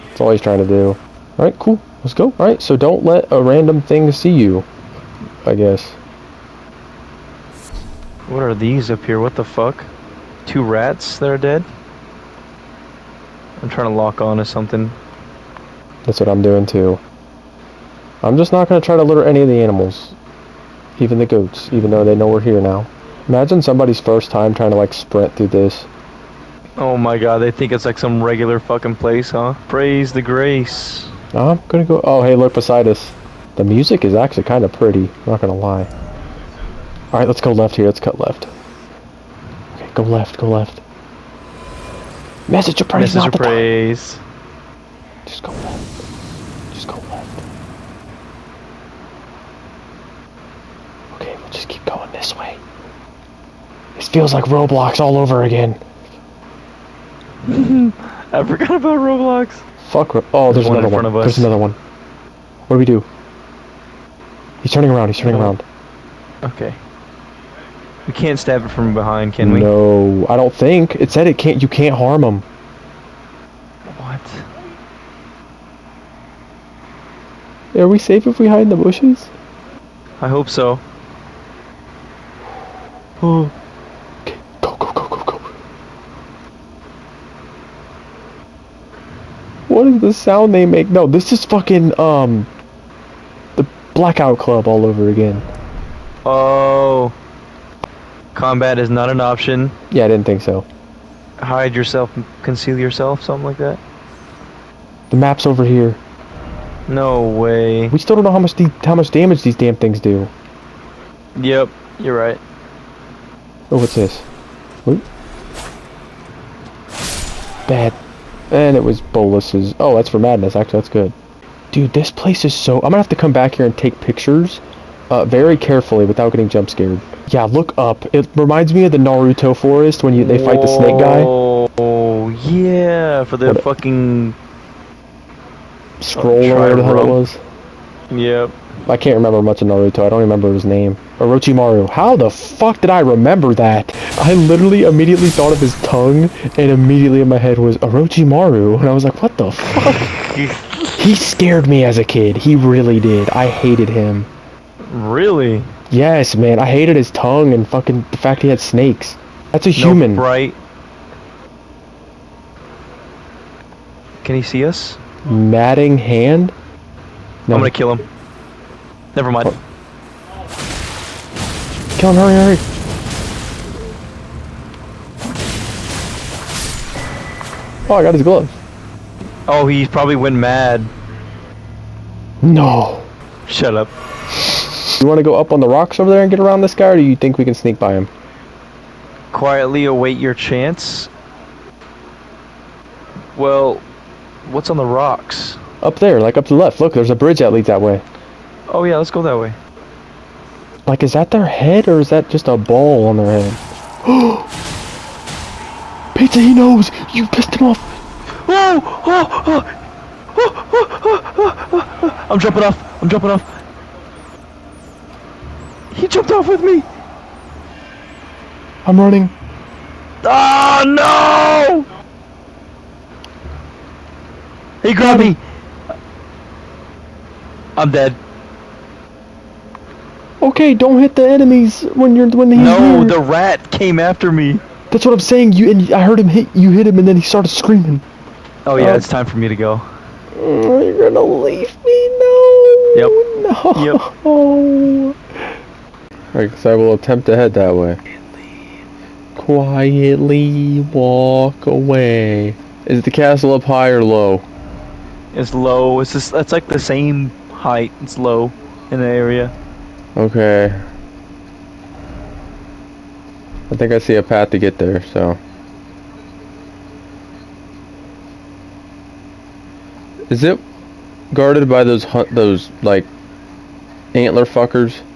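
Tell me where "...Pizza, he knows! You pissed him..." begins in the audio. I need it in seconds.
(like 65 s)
206 s.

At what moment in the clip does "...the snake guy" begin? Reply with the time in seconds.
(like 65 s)
130 s.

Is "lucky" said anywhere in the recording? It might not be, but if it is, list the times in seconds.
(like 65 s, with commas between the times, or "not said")
not said.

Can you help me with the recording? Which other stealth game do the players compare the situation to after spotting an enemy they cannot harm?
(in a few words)
The Blackout Club.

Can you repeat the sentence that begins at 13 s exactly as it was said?
I'm trying to lock on to something.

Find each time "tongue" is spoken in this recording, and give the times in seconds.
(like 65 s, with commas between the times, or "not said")
145 s, 157 s.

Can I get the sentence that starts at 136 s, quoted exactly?
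Scroll or whatever the hell it was.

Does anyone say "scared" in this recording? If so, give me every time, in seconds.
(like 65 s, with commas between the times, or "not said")
126 s, 151 s.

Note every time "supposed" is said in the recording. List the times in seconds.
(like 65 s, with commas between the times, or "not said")
not said.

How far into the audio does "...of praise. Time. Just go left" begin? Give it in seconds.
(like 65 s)
43 s.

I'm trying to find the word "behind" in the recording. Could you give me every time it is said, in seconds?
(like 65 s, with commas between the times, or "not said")
68 s.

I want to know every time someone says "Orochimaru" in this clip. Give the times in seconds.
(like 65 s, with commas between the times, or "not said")
141 s, 147 s.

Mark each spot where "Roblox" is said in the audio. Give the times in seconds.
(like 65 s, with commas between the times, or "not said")
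54 s, 58 s.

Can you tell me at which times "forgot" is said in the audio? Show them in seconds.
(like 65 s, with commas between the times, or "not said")
58 s.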